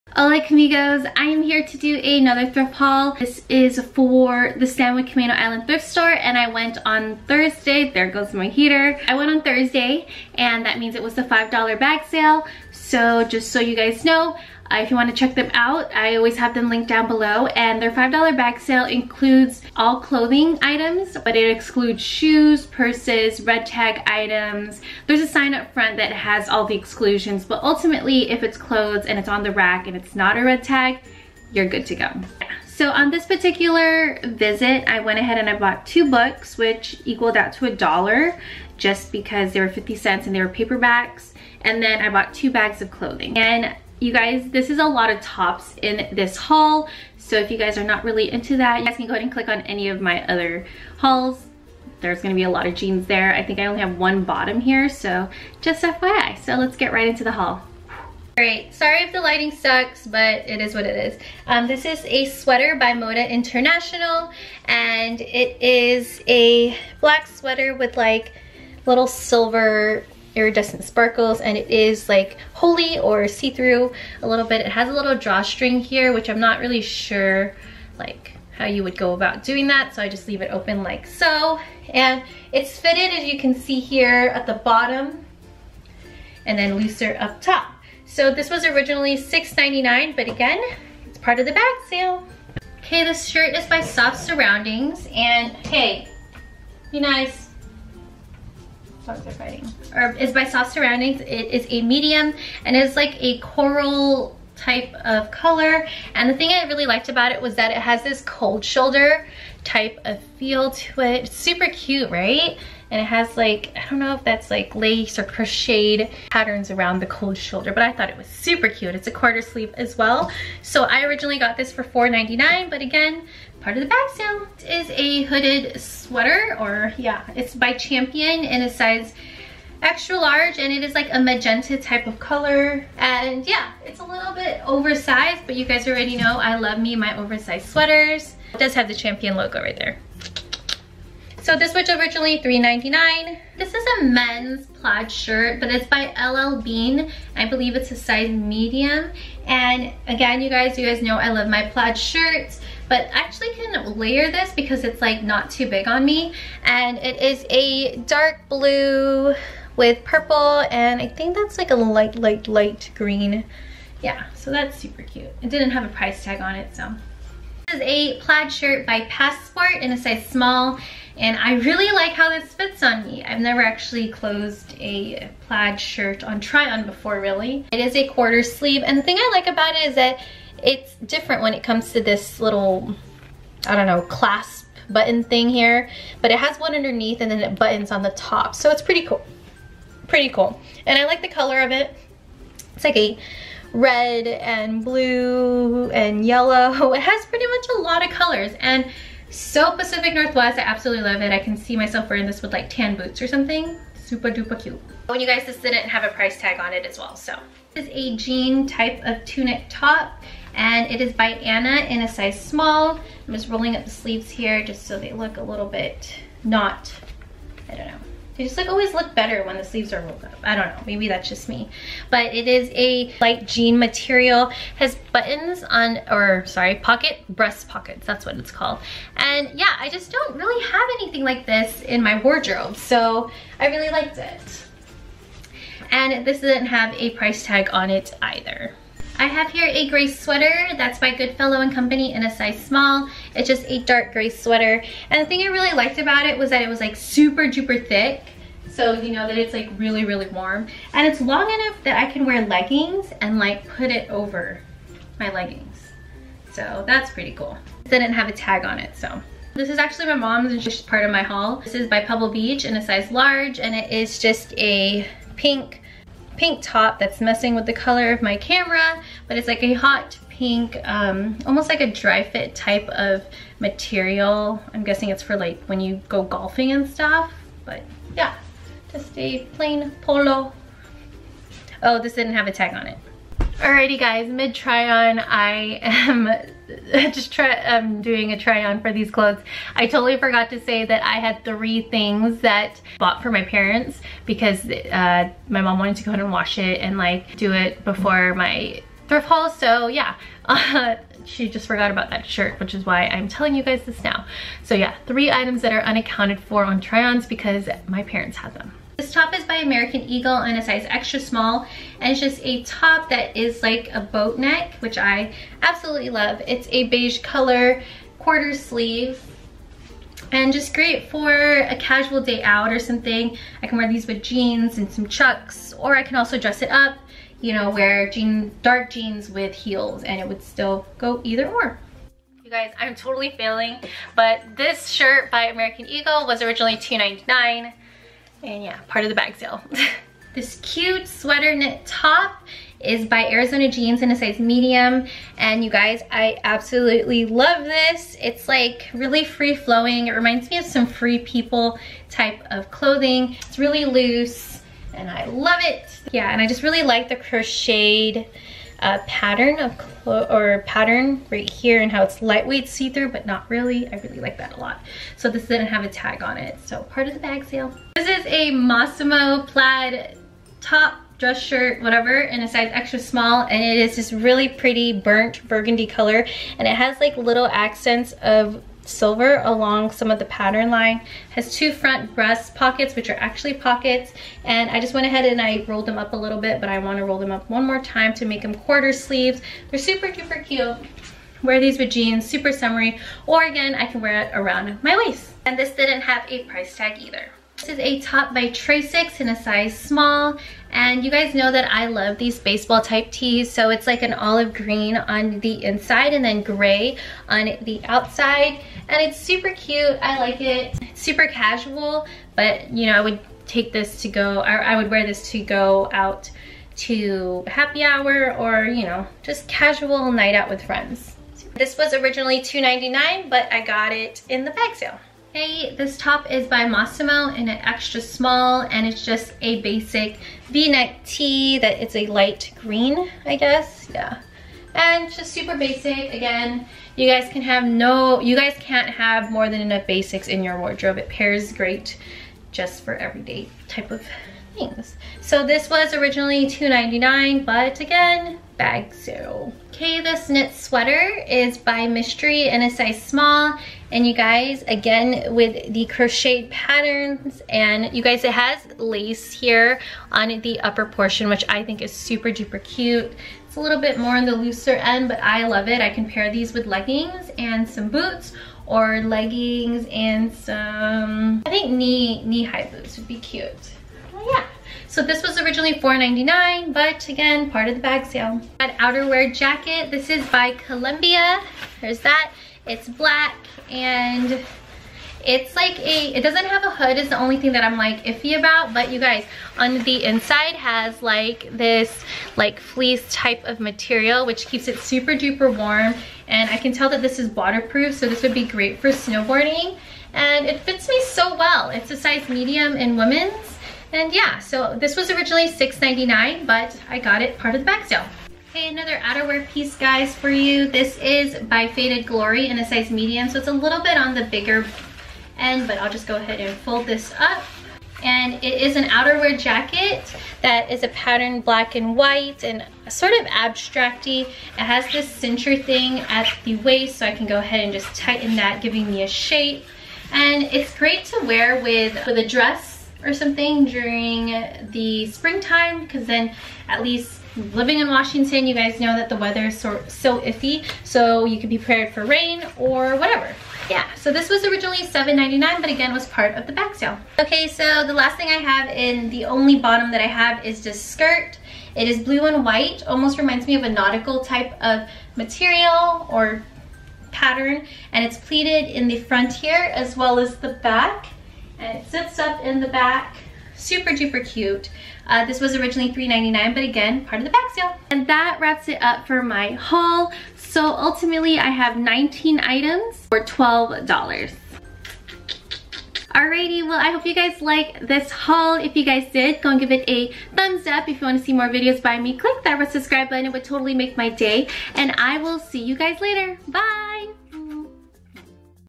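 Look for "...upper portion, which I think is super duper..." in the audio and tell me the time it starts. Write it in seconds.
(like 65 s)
460 s.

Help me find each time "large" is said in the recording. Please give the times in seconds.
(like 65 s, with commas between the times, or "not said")
130 s, 263 s.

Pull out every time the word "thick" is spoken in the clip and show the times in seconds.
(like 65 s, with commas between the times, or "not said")
247 s.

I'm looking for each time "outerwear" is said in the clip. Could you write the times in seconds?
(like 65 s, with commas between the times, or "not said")
478 s, 508 s, 518 s.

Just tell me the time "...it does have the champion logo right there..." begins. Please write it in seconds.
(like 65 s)
138 s.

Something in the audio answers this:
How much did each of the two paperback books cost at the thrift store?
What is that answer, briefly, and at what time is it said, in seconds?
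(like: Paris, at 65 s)
50 cents, at 39 s.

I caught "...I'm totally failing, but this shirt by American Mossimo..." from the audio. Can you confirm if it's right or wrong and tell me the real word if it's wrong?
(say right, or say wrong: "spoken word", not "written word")
wrong: "Eagle", not "Mossimo".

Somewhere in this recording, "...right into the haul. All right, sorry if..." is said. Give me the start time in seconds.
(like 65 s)
56 s.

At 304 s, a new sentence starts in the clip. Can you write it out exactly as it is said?
So yeah, three items that are unaccounted for on try-ons because my parents had them.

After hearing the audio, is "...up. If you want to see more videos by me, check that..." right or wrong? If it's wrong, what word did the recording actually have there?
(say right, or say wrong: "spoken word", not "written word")
wrong: "click", not "check".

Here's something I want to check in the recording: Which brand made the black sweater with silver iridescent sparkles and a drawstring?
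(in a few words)
Moda International.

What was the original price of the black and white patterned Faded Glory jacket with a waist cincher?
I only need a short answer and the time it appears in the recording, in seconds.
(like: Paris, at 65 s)
$7.99, at 544 s.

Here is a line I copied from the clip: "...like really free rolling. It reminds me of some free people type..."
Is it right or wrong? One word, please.
wrong.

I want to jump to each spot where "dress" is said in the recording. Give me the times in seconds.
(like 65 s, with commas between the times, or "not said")
326 s, 371 s, 532 s.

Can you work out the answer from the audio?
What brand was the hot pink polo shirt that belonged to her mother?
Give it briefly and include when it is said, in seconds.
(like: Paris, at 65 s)
Pebble Beach, at 262 s.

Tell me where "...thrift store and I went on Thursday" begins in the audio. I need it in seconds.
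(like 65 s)
5 s.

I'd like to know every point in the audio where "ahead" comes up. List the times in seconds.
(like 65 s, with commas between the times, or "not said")
35 s, 49 s, 296 s, 385 s, 516 s, 527 s.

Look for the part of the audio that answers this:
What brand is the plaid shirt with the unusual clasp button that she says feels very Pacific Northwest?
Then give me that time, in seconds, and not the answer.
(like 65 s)
169 s.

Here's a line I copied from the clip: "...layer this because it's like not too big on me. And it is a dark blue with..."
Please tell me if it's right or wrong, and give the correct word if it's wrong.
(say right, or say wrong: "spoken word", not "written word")
right.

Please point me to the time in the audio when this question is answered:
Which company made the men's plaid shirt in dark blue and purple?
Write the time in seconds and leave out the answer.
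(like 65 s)
146 s.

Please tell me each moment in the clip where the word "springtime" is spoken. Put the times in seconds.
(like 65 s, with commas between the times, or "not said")
535 s.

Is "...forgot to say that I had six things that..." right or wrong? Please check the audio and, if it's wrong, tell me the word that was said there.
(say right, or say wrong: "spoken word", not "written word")
wrong: "three", not "six".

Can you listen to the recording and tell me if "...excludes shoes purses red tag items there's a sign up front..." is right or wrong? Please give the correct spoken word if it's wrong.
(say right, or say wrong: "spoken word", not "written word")
right.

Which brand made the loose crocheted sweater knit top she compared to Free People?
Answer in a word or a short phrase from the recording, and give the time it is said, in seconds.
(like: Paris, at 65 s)
Arizona Jeans, at 343 s.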